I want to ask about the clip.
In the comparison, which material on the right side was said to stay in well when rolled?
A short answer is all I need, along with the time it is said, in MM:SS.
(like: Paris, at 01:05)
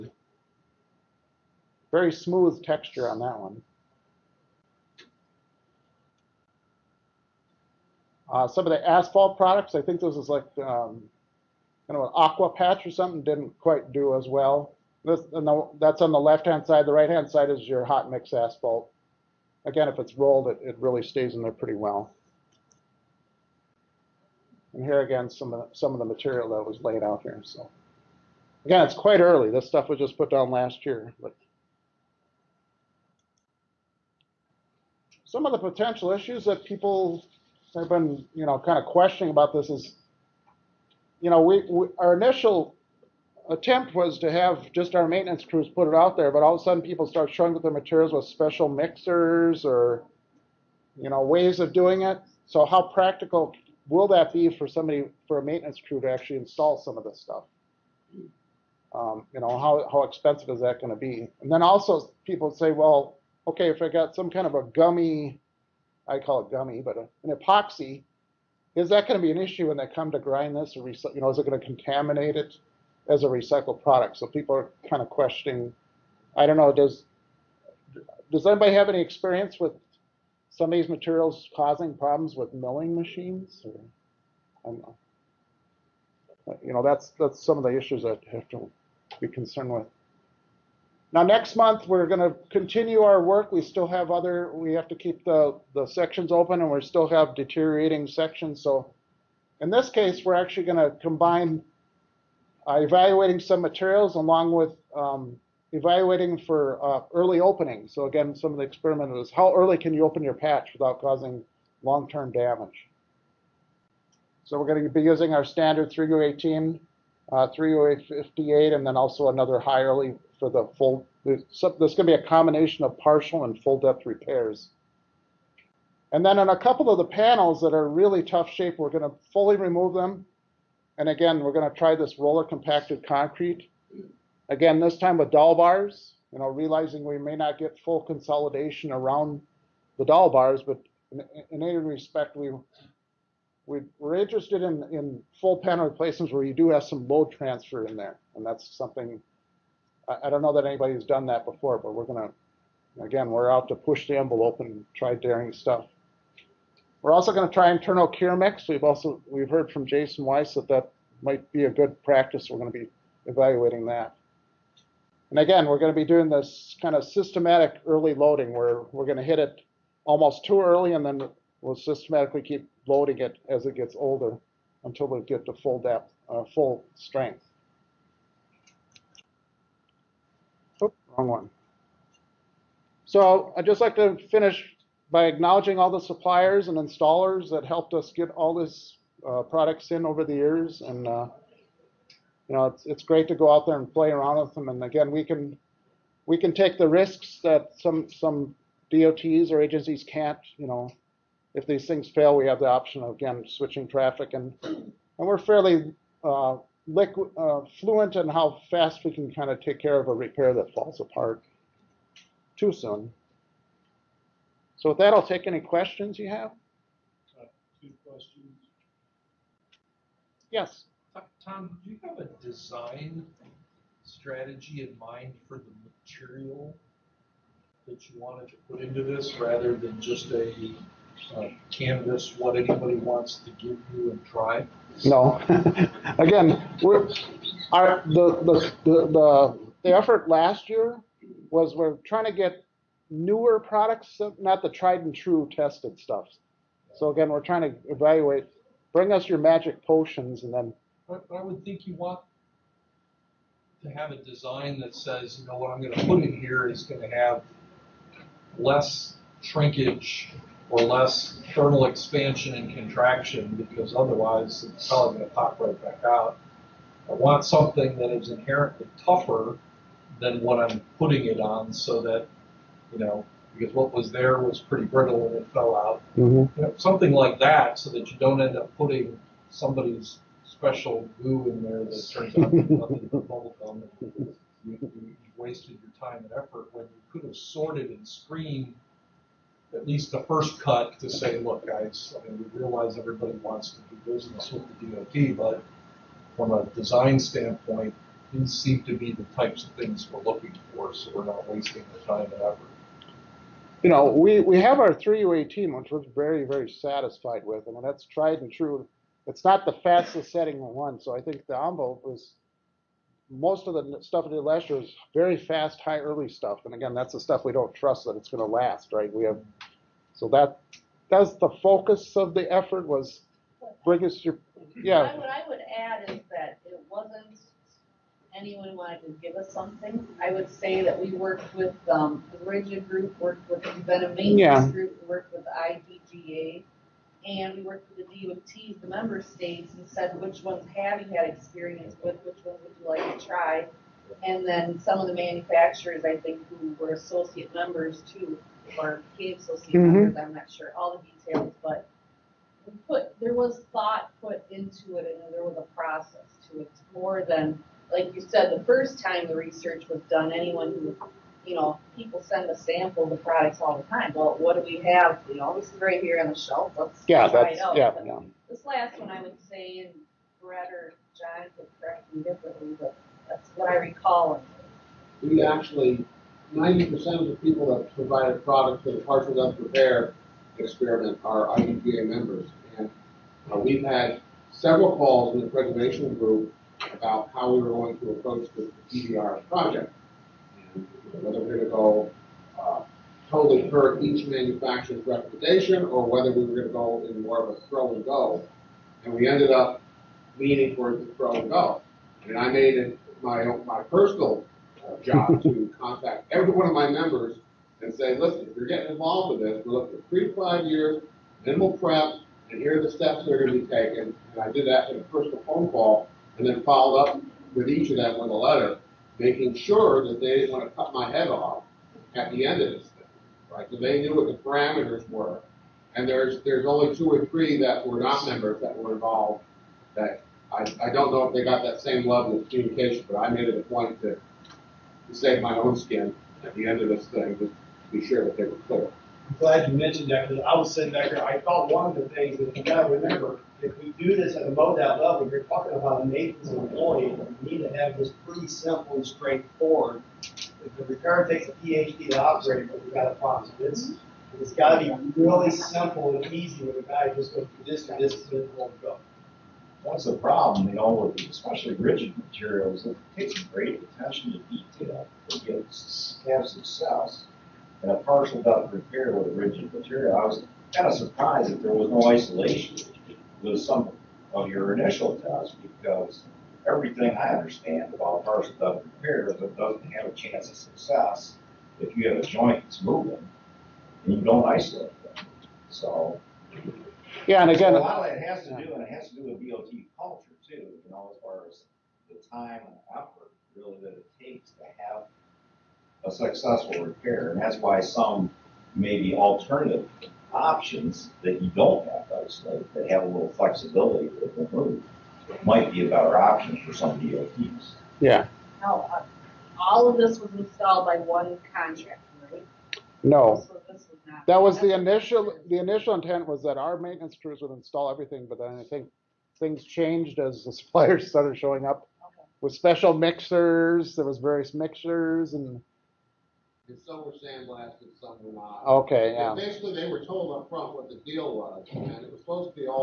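hot mix asphalt, at 00:17.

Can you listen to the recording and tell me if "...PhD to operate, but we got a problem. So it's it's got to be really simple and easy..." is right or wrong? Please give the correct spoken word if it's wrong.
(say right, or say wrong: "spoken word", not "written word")
right.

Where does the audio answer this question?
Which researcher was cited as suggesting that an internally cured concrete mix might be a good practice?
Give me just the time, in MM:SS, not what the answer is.
02:39.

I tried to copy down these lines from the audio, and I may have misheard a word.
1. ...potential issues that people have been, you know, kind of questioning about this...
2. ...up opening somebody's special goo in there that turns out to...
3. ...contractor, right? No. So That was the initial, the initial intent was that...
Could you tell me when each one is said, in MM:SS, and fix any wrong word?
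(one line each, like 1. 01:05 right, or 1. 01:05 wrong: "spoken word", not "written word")
1. 00:35 right
2. 04:38 wrong: "putting", not "opening"
3. 08:31 right.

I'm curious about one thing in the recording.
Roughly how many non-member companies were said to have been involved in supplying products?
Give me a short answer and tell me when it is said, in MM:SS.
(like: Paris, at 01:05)
2 or 3, at 07:06.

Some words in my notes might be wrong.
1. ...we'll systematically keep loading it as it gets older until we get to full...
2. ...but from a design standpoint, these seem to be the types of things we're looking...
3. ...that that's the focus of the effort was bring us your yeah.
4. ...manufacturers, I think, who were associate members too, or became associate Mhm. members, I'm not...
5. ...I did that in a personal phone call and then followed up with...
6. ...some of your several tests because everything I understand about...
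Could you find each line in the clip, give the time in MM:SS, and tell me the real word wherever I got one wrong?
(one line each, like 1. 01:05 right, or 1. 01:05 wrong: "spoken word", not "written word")
1. 02:51 right
2. 04:55 right
3. 05:20 right
4. 05:45 right
5. 06:54 right
6. 07:53 wrong: "initial", not "several".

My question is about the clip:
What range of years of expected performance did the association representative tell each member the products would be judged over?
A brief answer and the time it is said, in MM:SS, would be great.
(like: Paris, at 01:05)
3 to 5 years, at 06:50.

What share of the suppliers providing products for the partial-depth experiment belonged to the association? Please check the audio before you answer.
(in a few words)
90%.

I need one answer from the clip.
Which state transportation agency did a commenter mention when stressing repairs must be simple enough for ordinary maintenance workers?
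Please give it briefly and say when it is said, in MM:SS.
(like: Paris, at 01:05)
MoDOT, at 07:24.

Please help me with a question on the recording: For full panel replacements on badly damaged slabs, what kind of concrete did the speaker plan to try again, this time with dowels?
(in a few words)
roller compacted concrete.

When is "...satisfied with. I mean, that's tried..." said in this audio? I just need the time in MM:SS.
05:06.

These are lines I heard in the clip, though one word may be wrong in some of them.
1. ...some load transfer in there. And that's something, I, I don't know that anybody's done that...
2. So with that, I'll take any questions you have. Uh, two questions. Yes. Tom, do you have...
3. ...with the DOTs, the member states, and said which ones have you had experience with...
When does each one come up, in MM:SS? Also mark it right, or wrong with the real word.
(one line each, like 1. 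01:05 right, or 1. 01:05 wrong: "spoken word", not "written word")
1. 02:26 right
2. 03:34 right
3. 05:37 right.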